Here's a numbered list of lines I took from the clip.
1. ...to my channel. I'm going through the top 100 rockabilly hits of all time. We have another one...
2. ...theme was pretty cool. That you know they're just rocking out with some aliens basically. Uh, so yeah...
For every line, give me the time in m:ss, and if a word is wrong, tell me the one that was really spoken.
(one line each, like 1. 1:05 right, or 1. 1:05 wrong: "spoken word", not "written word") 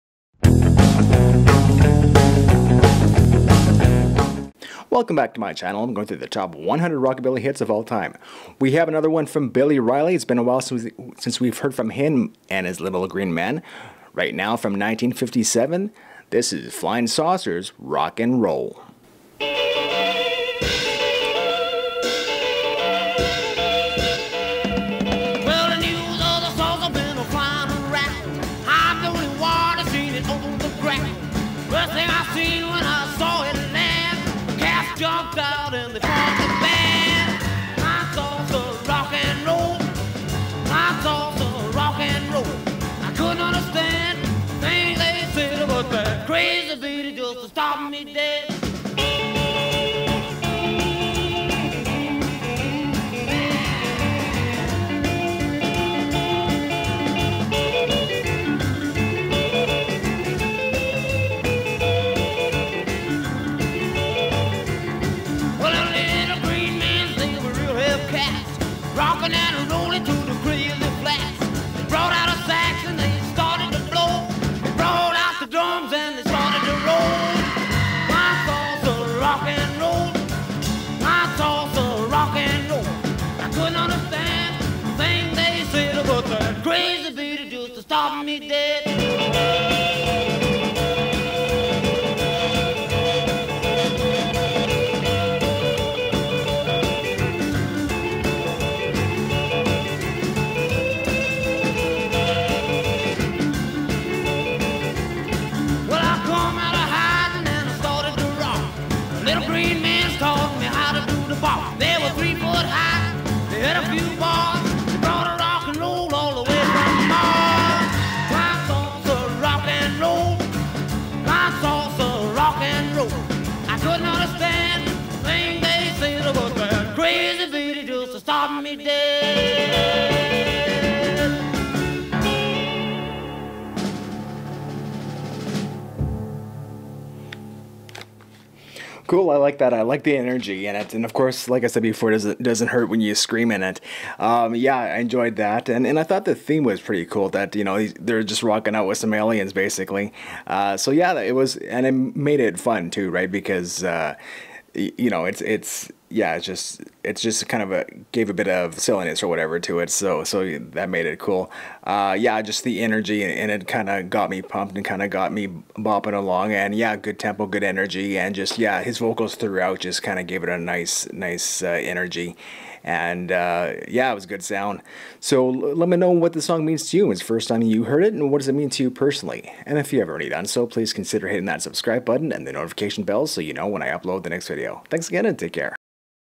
1. 0:05 right
2. 2:26 right.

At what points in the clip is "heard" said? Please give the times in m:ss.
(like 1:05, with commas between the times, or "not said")
0:11, 2:57.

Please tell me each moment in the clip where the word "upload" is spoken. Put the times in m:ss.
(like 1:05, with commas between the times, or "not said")
3:03.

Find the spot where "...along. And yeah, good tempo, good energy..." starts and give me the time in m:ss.
2:46.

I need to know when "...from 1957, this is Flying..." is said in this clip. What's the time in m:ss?
0:14.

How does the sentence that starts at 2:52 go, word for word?
And uh, yeah, it was good sound.